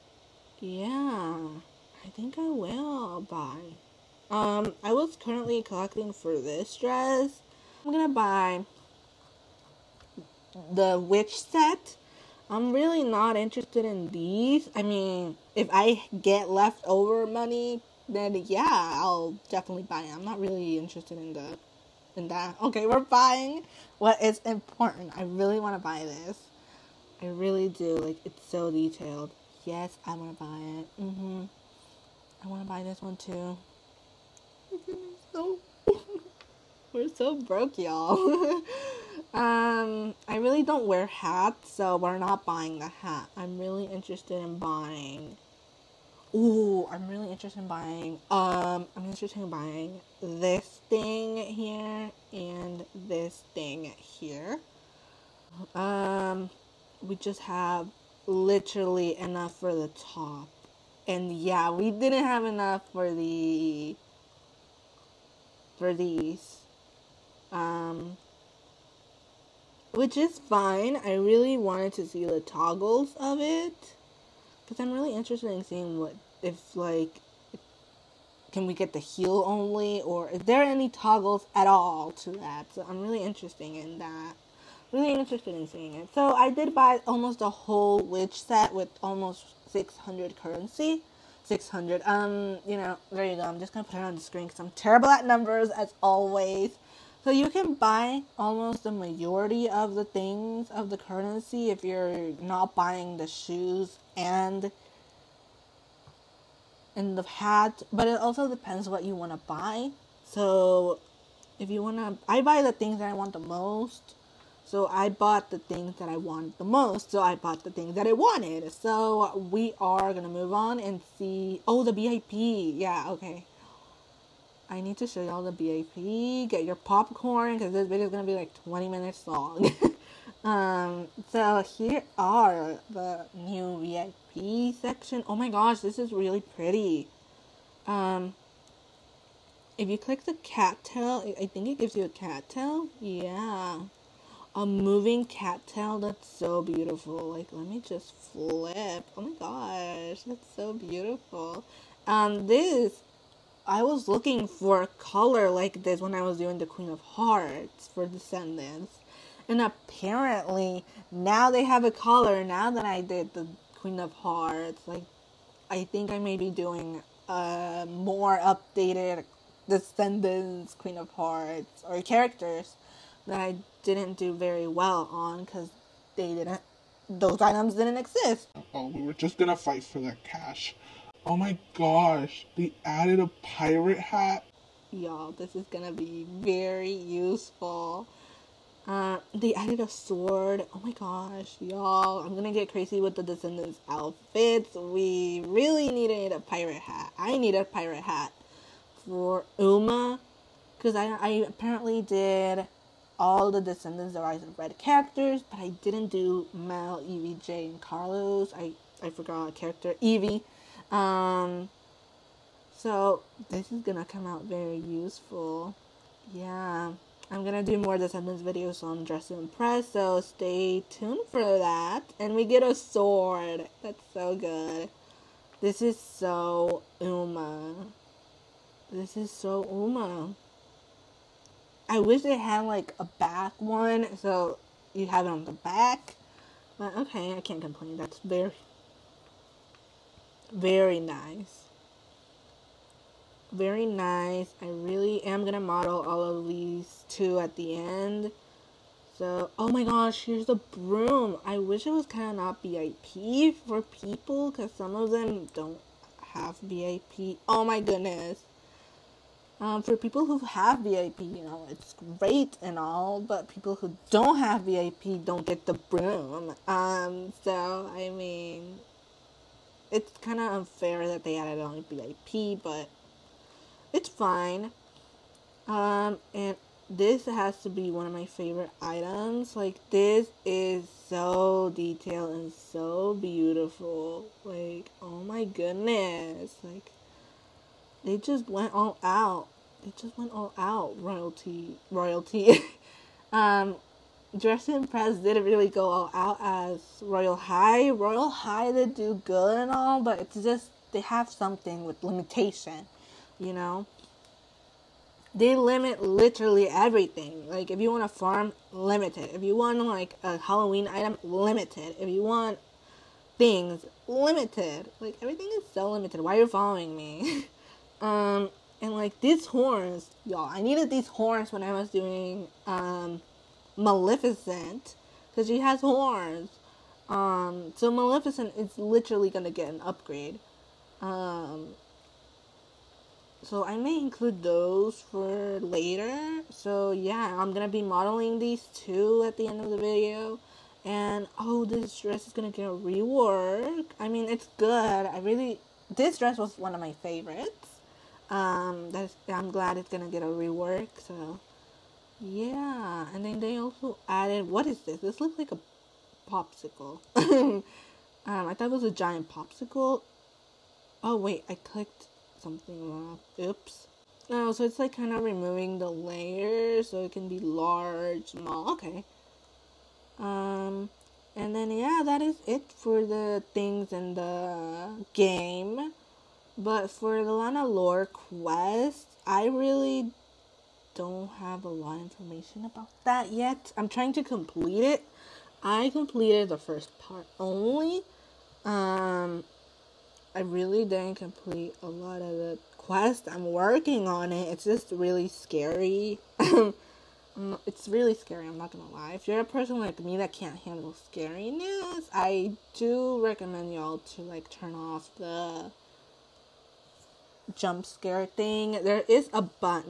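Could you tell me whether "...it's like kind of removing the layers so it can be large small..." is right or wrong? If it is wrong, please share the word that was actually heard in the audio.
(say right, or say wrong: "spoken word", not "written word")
right.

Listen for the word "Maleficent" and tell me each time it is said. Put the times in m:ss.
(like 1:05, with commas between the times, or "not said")
5:23, 5:27.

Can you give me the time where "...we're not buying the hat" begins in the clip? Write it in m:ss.
0:41.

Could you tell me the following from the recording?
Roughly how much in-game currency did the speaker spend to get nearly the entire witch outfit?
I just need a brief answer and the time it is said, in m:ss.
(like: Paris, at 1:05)
600, at 1:29.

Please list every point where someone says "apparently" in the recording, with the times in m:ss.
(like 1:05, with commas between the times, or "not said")
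2:39, 3:21.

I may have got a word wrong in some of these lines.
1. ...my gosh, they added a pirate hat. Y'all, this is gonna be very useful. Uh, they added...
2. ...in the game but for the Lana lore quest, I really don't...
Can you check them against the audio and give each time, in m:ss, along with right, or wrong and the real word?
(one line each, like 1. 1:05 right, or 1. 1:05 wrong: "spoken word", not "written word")
1. 3:01 right
2. 6:13 right.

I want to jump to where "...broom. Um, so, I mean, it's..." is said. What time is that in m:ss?
4:25.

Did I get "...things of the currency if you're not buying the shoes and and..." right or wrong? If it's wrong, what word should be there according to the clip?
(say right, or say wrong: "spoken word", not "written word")
right.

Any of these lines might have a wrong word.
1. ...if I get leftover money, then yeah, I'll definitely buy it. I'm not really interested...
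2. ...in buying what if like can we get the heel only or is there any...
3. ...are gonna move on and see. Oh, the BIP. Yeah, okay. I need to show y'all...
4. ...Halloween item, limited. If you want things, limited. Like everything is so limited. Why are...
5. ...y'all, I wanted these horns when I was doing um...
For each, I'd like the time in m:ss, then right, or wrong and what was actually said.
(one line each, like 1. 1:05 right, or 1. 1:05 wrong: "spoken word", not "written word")
1. 0:15 right
2. 1:15 wrong: "seeing", not "buying"
3. 1:59 wrong: "VIP", not "BIP"
4. 5:10 right
5. 5:20 wrong: "needed", not "wanted".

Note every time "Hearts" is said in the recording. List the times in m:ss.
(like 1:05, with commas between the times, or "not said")
2:37, 2:44, 2:51.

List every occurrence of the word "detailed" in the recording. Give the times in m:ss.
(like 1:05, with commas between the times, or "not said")
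0:28, 4:41.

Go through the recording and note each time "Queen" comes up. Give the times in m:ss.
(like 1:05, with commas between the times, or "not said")
2:36, 2:43, 2:50.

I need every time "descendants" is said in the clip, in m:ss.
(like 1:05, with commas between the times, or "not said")
2:38, 2:49, 3:13, 3:23, 3:37.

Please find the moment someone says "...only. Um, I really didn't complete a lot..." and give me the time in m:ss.
6:27.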